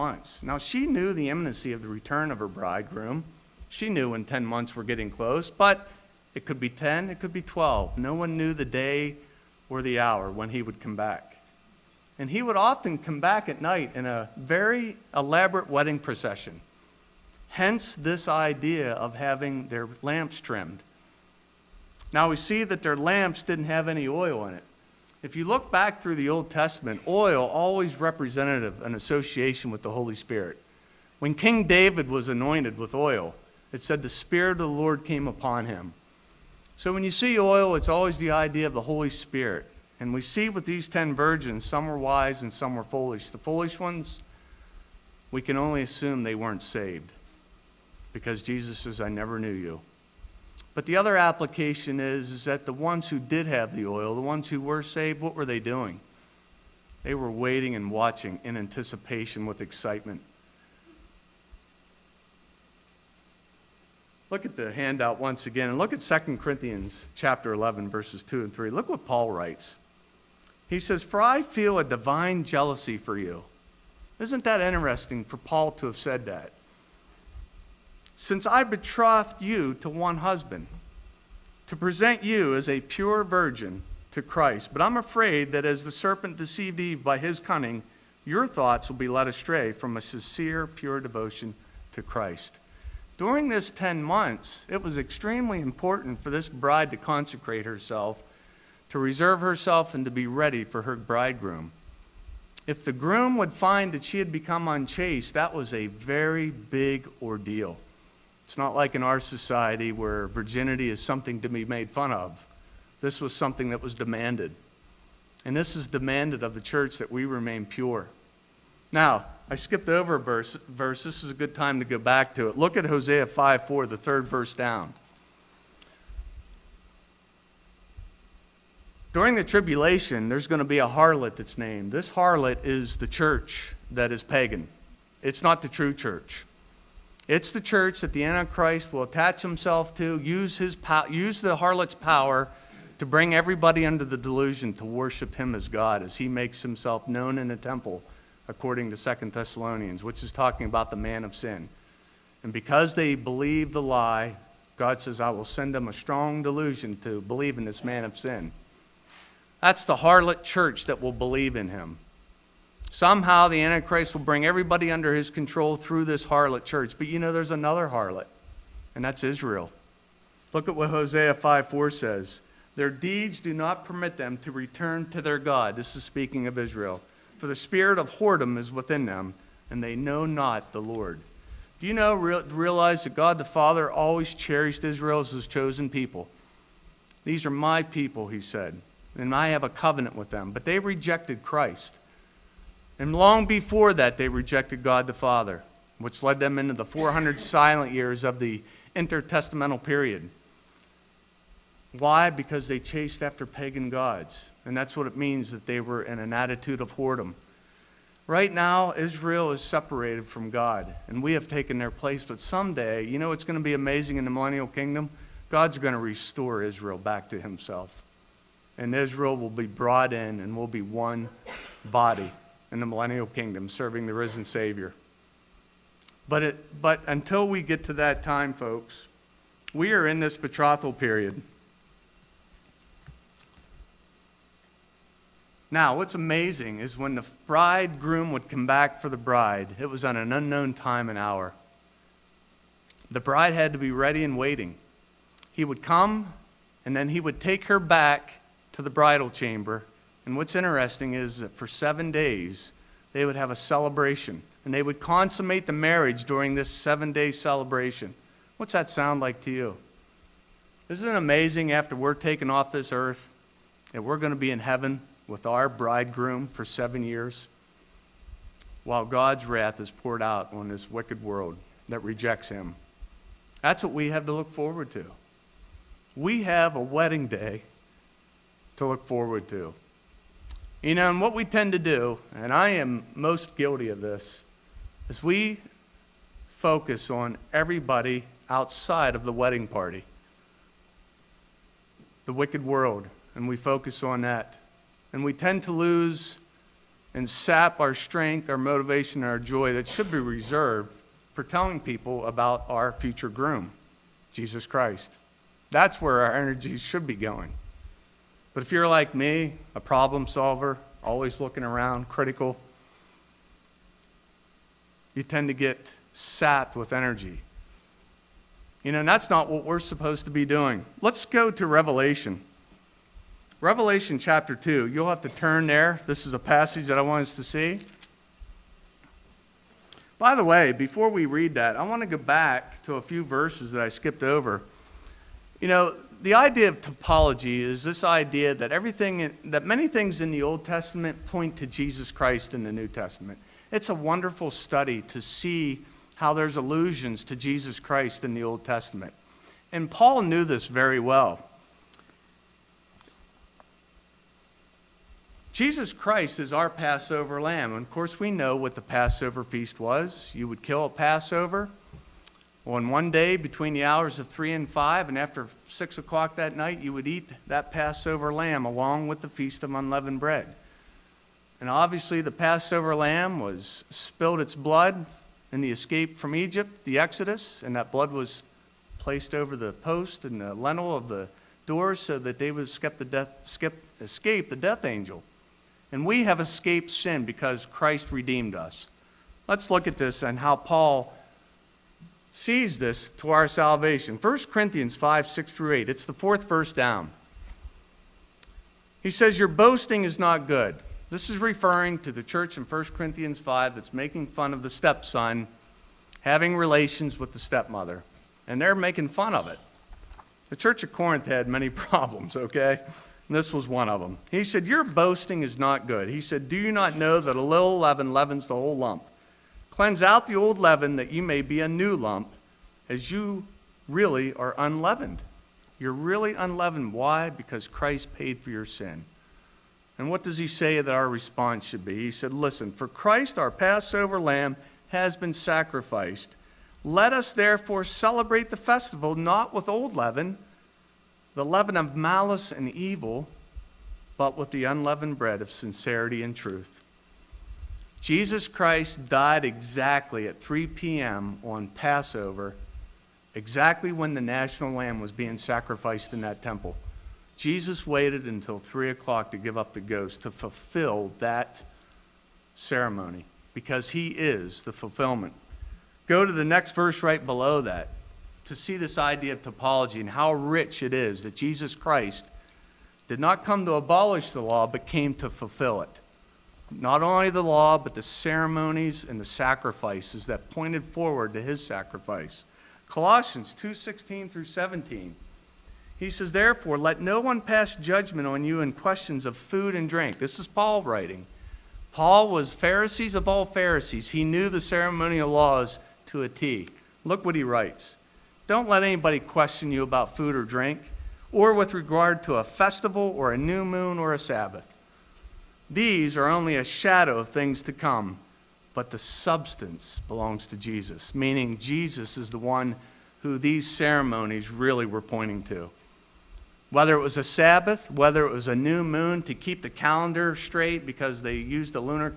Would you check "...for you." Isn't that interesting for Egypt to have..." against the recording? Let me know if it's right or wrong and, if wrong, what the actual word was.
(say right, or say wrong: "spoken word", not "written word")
wrong: "Paul", not "Egypt".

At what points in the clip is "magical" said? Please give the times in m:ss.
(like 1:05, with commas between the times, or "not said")
not said.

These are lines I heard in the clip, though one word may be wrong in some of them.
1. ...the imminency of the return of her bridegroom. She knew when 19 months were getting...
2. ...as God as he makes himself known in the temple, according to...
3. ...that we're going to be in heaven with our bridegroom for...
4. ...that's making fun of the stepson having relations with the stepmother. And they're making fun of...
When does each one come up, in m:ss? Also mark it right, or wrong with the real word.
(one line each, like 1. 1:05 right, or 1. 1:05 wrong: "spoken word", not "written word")
1. 0:01 wrong: "10", not "19"
2. 2:25 right
3. 4:23 right
4. 6:43 right.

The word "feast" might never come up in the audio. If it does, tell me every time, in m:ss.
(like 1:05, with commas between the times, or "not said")
5:59, 6:09.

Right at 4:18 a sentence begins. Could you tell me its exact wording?
What's that sound like to you?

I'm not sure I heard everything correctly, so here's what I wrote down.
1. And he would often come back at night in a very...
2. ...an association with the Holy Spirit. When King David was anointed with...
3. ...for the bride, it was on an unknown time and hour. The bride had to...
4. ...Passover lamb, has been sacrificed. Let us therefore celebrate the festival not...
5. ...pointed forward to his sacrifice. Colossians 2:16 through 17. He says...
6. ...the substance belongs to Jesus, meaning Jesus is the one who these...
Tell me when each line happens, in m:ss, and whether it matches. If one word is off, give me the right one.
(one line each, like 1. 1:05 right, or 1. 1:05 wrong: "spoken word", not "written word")
1. 0:12 right
2. 0:28 right
3. 3:59 right
4. 7:13 right
5. 8:00 right
6. 8:28 right.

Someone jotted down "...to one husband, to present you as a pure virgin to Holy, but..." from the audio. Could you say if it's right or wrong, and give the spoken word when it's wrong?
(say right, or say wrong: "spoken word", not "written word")
wrong: "Christ", not "Holy".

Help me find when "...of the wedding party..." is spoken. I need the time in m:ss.
4:49.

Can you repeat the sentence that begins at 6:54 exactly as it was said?
He said, Your boasting is not good.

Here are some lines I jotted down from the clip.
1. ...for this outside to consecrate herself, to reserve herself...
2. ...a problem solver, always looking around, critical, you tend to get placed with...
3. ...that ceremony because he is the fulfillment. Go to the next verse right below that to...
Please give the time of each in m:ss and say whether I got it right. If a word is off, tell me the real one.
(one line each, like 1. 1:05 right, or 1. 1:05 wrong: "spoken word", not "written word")
1. 1:36 wrong: "bride", not "outside"
2. 5:09 wrong: "sapped", not "placed"
3. 7:41 right.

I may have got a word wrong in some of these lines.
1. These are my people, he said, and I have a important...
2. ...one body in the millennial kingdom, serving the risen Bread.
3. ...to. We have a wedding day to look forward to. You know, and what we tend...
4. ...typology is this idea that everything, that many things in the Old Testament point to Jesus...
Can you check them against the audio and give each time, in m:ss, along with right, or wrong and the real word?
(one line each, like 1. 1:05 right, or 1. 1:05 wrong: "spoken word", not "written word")
1. 3:07 wrong: "covenant", not "important"
2. 3:40 wrong: "Savior", not "Bread"
3. 4:34 right
4. 5:36 right.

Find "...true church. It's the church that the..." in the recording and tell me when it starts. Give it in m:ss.
2:15.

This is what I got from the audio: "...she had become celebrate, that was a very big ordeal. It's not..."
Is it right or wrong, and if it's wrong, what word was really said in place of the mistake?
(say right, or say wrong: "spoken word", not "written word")
wrong: "unchaste", not "celebrate".